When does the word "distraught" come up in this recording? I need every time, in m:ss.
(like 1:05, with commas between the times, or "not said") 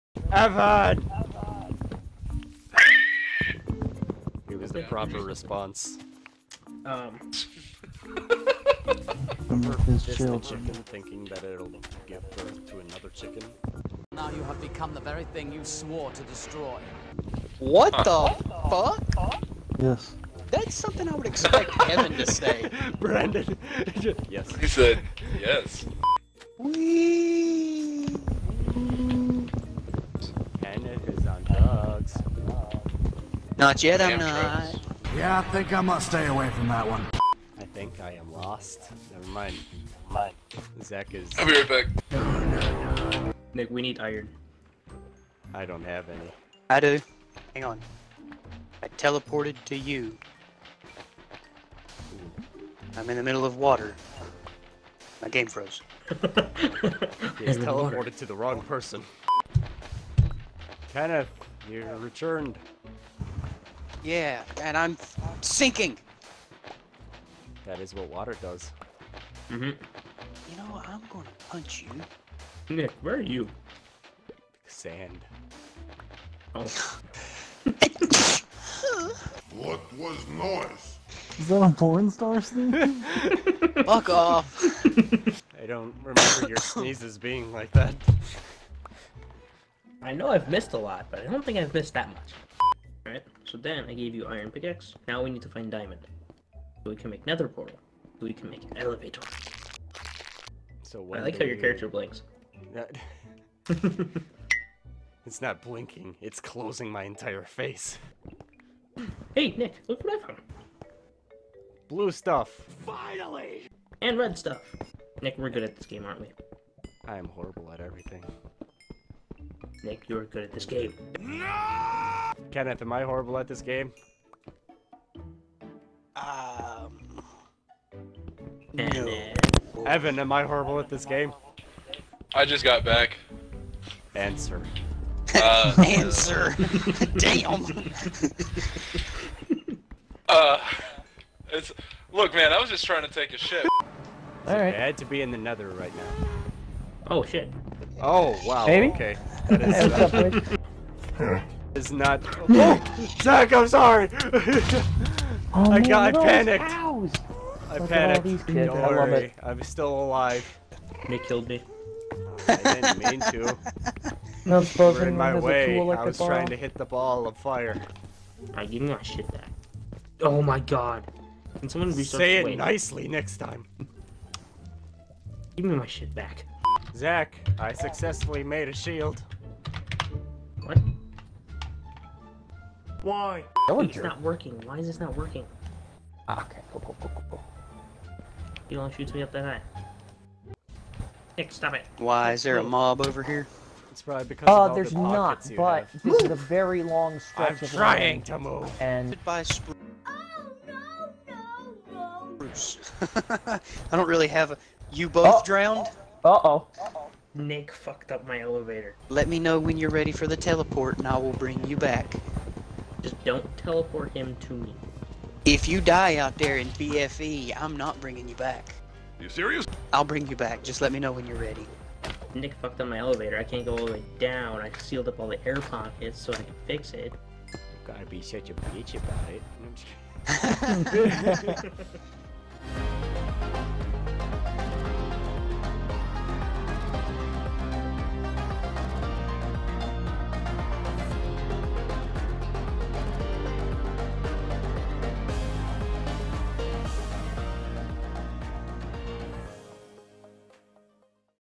not said.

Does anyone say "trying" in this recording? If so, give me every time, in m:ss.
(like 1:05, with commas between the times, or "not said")
2:22, 2:46, 3:17.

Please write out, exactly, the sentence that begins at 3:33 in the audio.
Just don't teleport him to me.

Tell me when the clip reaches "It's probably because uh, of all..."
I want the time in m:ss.
3:13.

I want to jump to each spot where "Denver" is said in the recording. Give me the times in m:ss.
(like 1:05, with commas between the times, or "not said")
not said.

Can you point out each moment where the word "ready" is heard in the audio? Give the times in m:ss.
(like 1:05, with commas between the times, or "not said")
3:29, 3:41.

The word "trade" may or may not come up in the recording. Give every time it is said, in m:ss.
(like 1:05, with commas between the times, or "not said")
not said.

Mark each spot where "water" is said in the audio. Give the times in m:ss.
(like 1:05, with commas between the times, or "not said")
0:53, 1:08.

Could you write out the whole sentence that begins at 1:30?
I know I've missed a lot, but I don't think I've missed that much.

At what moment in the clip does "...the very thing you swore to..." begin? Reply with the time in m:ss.
0:14.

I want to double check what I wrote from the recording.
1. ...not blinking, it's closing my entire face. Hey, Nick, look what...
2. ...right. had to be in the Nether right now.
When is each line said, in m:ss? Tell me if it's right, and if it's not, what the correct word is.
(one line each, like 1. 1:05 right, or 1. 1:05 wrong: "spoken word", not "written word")
1. 1:45 right
2. 2:24 right.